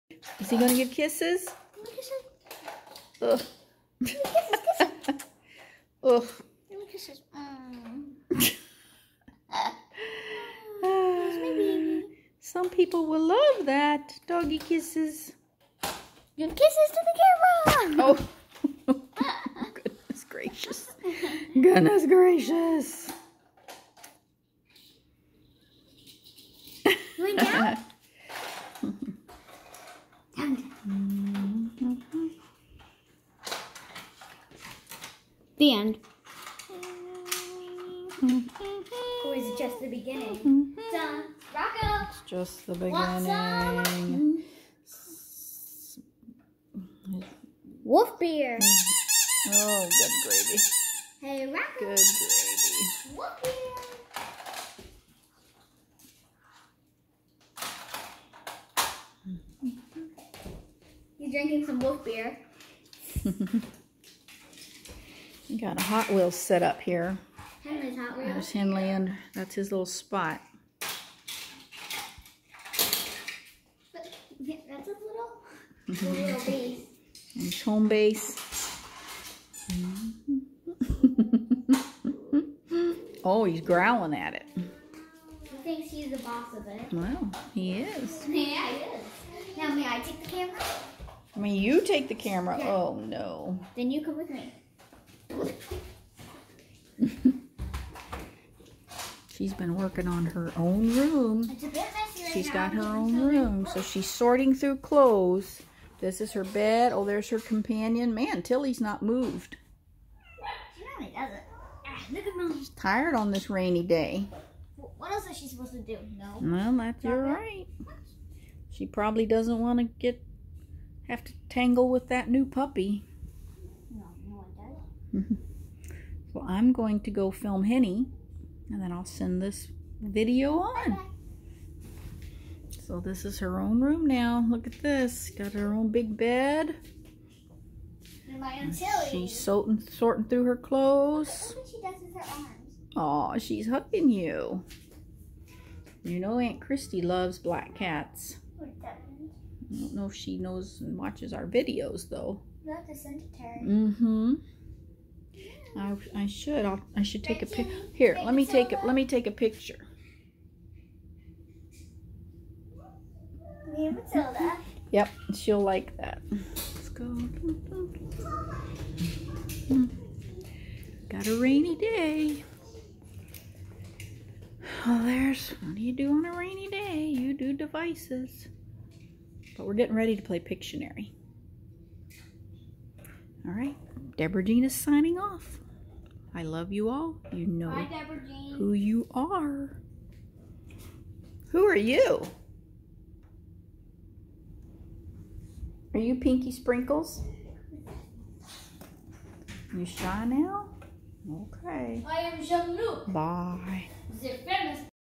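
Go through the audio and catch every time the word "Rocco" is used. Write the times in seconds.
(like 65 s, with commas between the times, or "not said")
41 s, 51 s.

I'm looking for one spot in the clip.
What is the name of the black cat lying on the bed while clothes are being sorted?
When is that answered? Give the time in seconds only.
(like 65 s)
108 s.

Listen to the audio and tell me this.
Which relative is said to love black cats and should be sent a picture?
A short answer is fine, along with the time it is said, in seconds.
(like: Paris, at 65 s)
Aunt Christy, at 146 s.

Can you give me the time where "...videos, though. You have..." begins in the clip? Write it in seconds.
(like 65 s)
151 s.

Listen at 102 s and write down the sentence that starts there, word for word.
She's got her own room, so she's sorting through clothes.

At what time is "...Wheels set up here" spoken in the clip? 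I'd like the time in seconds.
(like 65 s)
66 s.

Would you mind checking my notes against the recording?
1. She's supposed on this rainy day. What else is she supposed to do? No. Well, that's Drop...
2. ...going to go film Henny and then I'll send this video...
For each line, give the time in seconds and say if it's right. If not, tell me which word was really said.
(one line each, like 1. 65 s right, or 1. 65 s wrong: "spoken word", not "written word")
1. 112 s wrong: "tired", not "supposed"
2. 126 s right.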